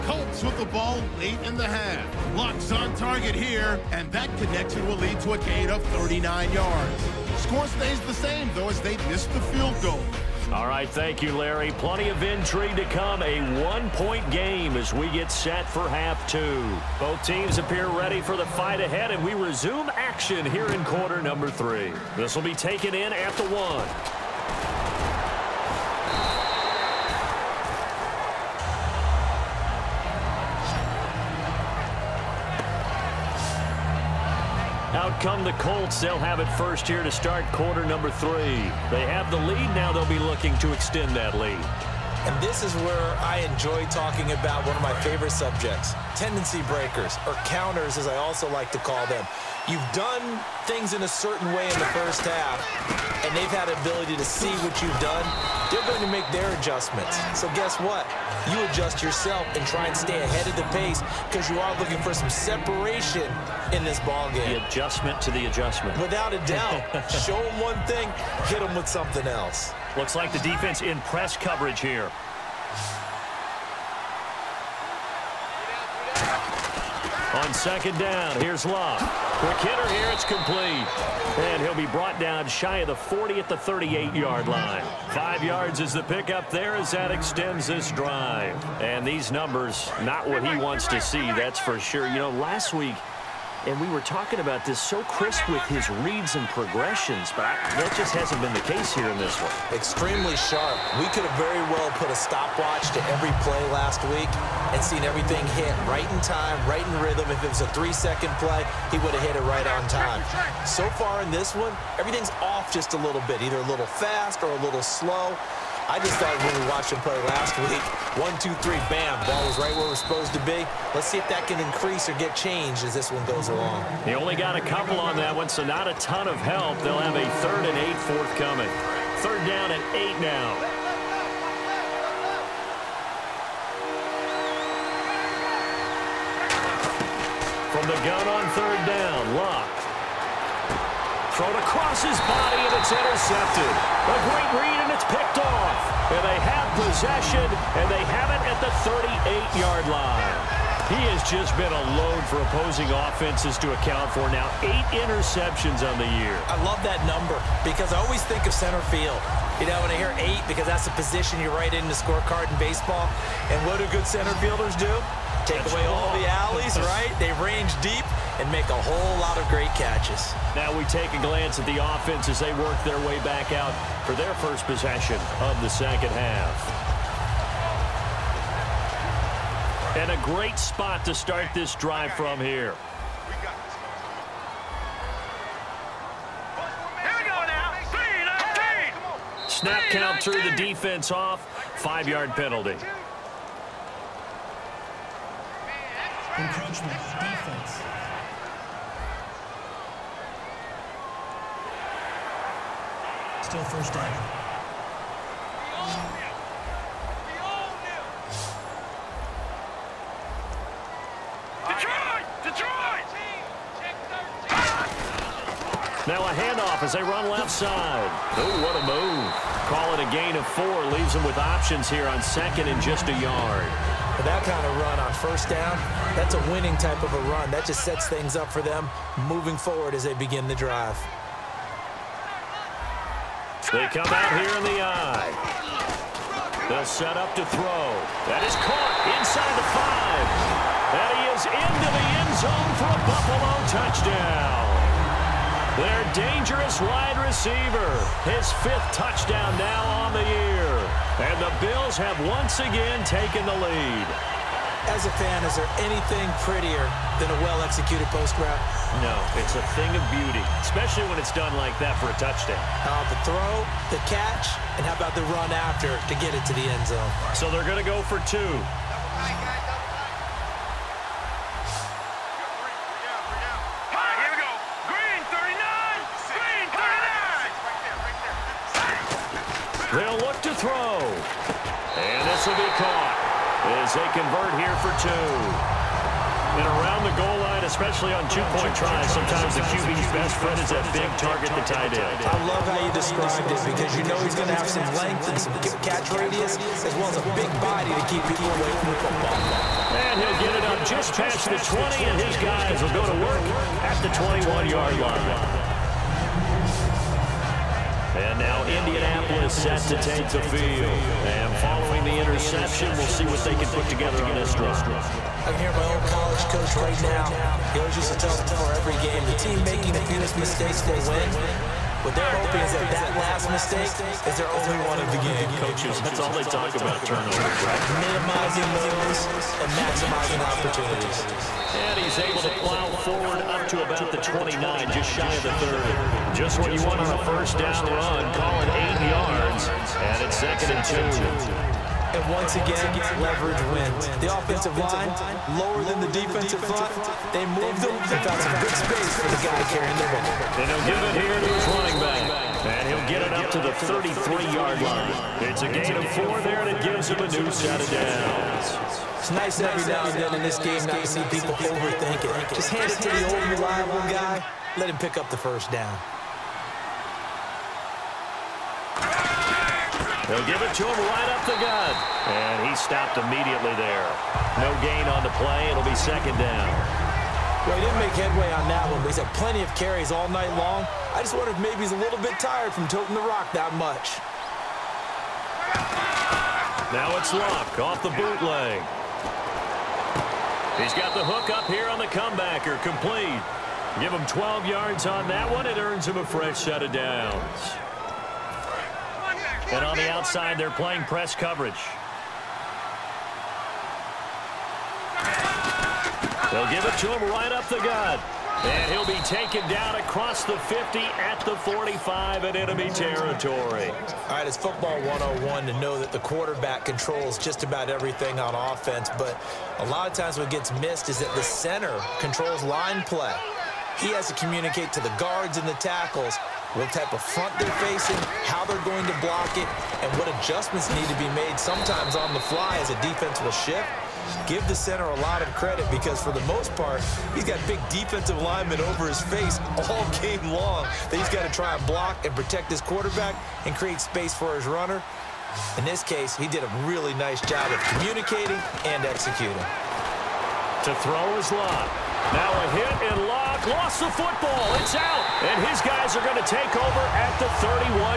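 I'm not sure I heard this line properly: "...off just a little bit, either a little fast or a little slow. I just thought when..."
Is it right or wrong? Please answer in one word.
right.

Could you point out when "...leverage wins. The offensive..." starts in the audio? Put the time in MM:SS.
05:43.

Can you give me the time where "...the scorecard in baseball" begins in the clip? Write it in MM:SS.
02:41.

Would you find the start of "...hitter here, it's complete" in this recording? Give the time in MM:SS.
01:19.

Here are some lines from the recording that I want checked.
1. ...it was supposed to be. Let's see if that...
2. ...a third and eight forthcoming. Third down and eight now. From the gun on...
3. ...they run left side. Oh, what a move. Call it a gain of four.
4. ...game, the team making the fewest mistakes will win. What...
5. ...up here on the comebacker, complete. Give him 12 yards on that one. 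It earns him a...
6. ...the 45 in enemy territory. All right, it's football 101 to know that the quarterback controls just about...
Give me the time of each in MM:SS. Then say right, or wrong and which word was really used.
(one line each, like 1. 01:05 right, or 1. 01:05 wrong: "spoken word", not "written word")
1. 01:59 right
2. 02:07 right
3. 03:36 right
4. 05:18 right
5. 06:31 right
6. 06:51 right.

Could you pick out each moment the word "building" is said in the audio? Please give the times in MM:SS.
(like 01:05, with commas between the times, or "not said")
not said.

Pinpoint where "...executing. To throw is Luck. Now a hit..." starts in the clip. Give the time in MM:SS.
07:29.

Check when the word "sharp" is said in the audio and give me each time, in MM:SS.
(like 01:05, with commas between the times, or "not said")
01:40.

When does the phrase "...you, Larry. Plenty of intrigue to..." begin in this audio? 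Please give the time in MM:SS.
00:11.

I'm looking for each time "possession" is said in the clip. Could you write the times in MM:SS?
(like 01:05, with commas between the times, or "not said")
02:26, 02:54.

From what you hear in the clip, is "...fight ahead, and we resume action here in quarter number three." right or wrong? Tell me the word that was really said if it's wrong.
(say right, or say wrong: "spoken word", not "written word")
right.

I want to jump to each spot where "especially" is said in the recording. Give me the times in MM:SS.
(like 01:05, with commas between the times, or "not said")
04:20, 04:47.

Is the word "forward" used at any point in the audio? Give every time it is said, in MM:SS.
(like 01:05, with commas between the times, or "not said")
03:49, 05:32.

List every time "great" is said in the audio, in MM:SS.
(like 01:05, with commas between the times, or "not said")
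02:24, 02:49, 03:00.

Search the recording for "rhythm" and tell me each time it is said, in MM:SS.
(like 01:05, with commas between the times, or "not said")
01:47.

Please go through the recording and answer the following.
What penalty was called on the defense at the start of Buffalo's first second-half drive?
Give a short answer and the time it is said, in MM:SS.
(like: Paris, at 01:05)
Encroachment, at 03:16.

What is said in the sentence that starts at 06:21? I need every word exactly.
I just wonder if maybe he's a little bit tired from toting the rock that much.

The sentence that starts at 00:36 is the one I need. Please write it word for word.
They'll have it first here to start quarter number three.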